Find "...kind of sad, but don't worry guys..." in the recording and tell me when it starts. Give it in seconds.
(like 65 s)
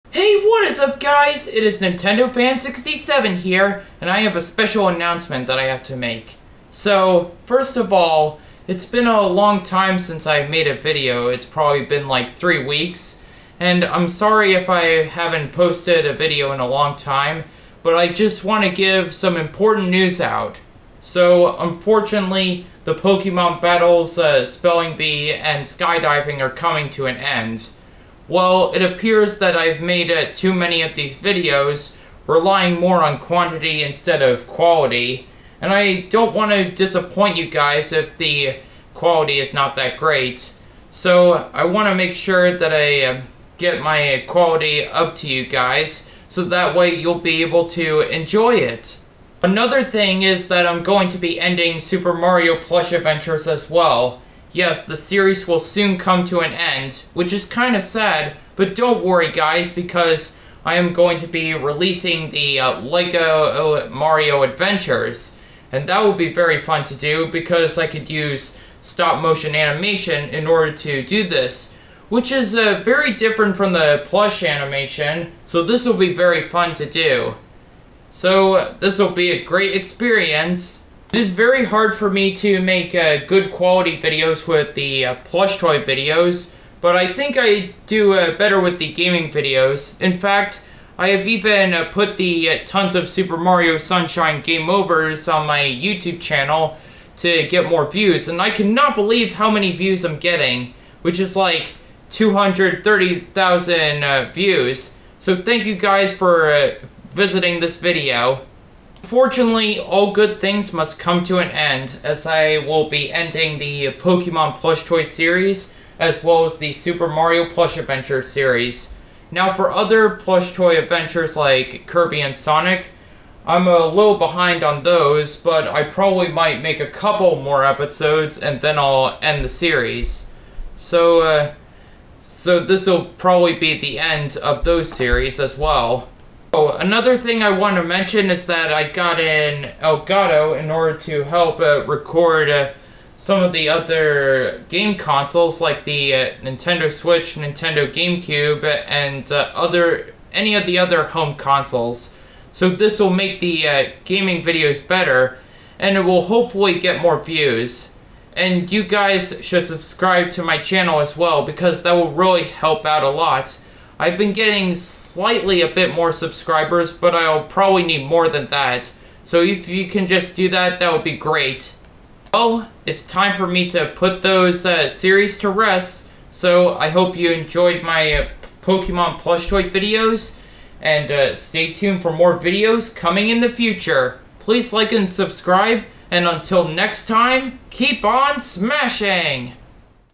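57 s.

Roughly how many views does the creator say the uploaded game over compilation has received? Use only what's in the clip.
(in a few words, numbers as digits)
230,000.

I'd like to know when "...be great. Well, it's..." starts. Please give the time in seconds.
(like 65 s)
171 s.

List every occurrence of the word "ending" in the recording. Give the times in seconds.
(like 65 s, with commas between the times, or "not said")
51 s, 113 s.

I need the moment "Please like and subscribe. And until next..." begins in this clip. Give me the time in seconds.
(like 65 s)
184 s.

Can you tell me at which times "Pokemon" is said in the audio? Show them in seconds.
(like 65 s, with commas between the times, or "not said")
22 s, 113 s, 178 s.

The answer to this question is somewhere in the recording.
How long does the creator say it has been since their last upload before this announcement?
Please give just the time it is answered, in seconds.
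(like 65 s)
12 s.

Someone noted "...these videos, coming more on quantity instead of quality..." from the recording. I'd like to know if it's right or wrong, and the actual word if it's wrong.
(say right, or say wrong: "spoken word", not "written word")
wrong: "relying", not "coming".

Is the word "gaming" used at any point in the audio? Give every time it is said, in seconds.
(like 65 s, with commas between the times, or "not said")
88 s, 154 s.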